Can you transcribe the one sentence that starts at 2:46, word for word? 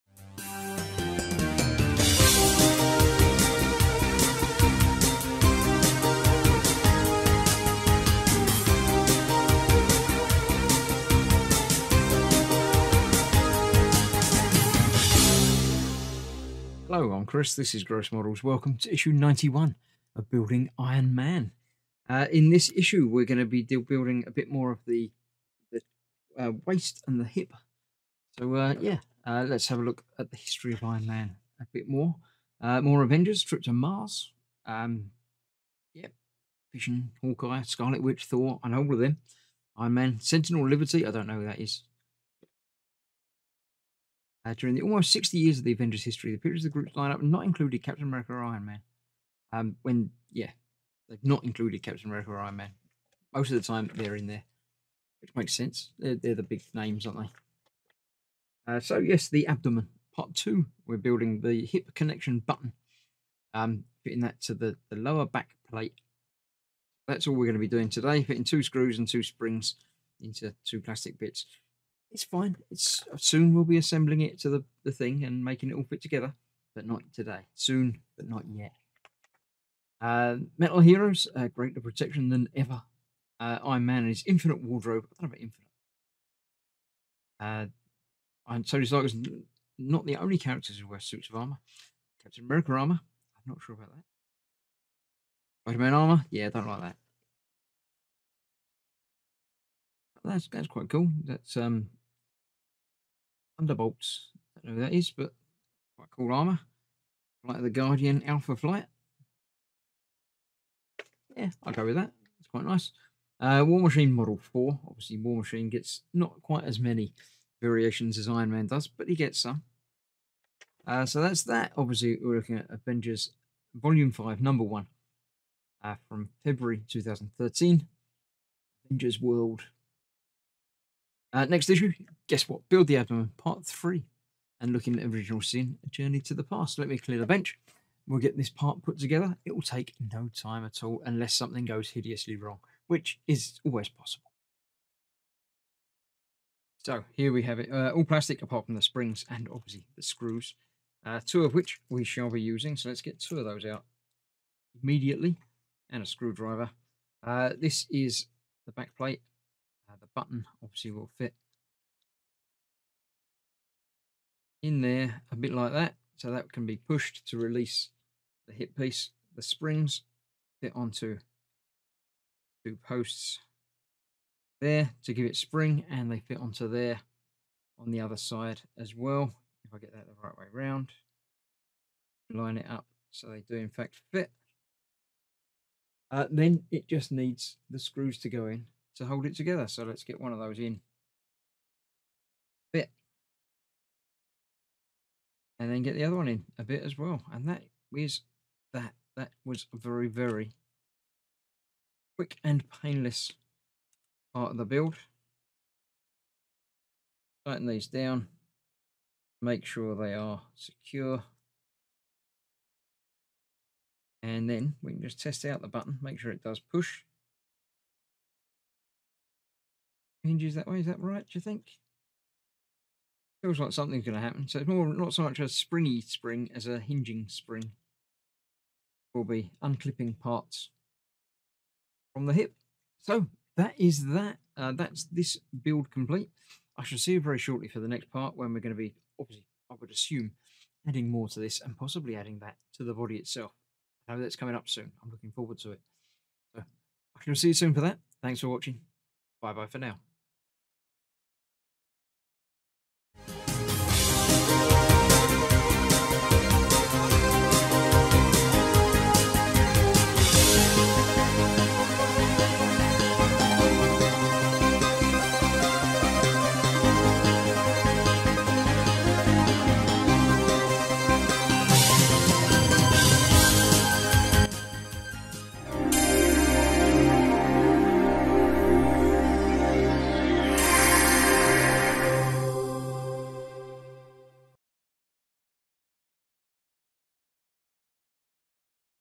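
So that can be pushed to release the hip piece.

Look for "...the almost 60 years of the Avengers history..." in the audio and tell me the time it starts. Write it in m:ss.
0:44.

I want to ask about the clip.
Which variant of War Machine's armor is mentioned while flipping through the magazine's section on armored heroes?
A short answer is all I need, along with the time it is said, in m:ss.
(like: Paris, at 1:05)
Model 4, at 1:54.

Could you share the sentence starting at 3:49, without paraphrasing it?
Will be unclipping parts from the hip.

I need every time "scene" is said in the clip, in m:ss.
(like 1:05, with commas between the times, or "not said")
2:15.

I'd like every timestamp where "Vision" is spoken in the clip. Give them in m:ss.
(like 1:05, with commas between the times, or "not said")
0:36.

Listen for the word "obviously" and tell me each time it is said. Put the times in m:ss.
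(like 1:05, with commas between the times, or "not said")
1:54, 2:01, 2:29, 2:40, 3:59.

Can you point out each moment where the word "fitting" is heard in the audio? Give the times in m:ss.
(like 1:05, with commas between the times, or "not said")
1:04, 1:08.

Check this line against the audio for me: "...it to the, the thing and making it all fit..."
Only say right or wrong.
right.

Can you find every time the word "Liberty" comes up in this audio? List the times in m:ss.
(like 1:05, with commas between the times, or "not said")
0:40.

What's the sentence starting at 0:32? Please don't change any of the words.
Uh, more Avengers, trip to Mars.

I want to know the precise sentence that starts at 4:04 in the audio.
I know that's coming up soon.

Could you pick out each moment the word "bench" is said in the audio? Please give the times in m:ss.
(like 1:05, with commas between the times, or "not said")
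2:17.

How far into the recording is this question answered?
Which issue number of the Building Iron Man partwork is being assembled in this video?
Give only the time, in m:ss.
0:18.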